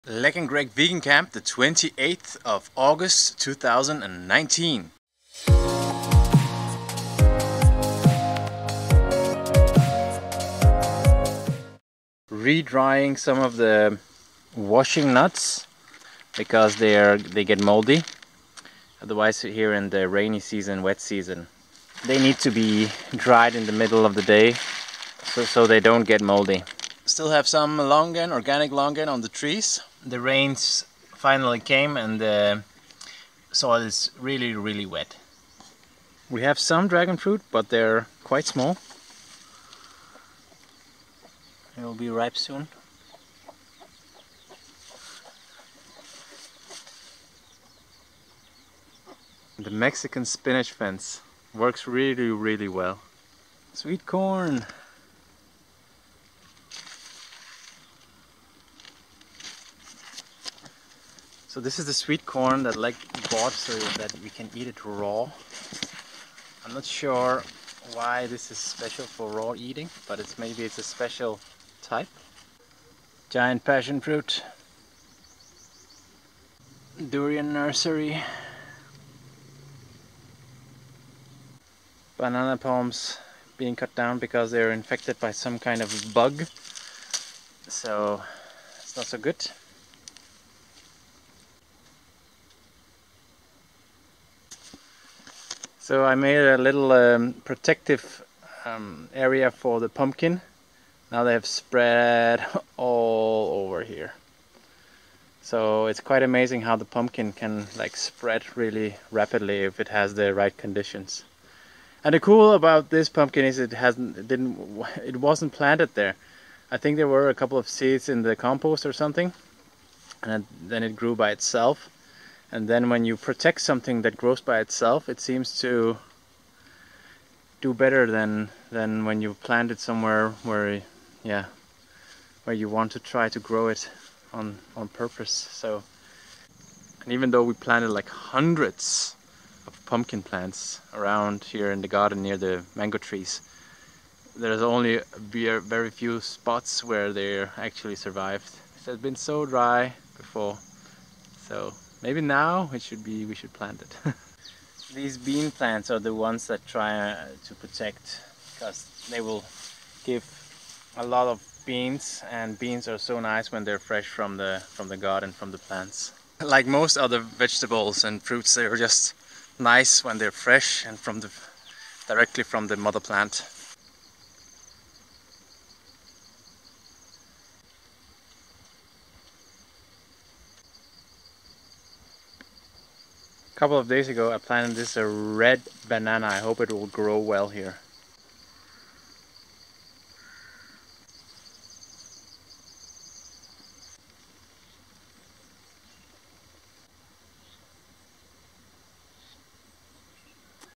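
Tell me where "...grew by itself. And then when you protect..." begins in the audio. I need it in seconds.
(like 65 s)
120 s.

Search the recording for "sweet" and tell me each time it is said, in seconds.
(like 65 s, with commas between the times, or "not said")
53 s, 61 s.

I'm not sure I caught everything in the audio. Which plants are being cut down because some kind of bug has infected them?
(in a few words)
Banana palms.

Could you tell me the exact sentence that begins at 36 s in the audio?
We have some dragon fruit but they're quite small.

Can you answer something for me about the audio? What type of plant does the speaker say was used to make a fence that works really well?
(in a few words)
Mexican spinach.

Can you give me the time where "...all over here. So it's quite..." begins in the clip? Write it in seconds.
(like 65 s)
102 s.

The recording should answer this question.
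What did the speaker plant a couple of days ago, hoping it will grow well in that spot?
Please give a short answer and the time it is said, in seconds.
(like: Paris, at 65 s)
Red banana, at 185 s.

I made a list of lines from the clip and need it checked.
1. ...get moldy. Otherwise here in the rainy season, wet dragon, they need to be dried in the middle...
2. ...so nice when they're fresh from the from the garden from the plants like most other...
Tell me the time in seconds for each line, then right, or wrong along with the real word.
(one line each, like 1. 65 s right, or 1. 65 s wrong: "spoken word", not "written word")
1. 17 s wrong: "season", not "dragon"
2. 162 s right.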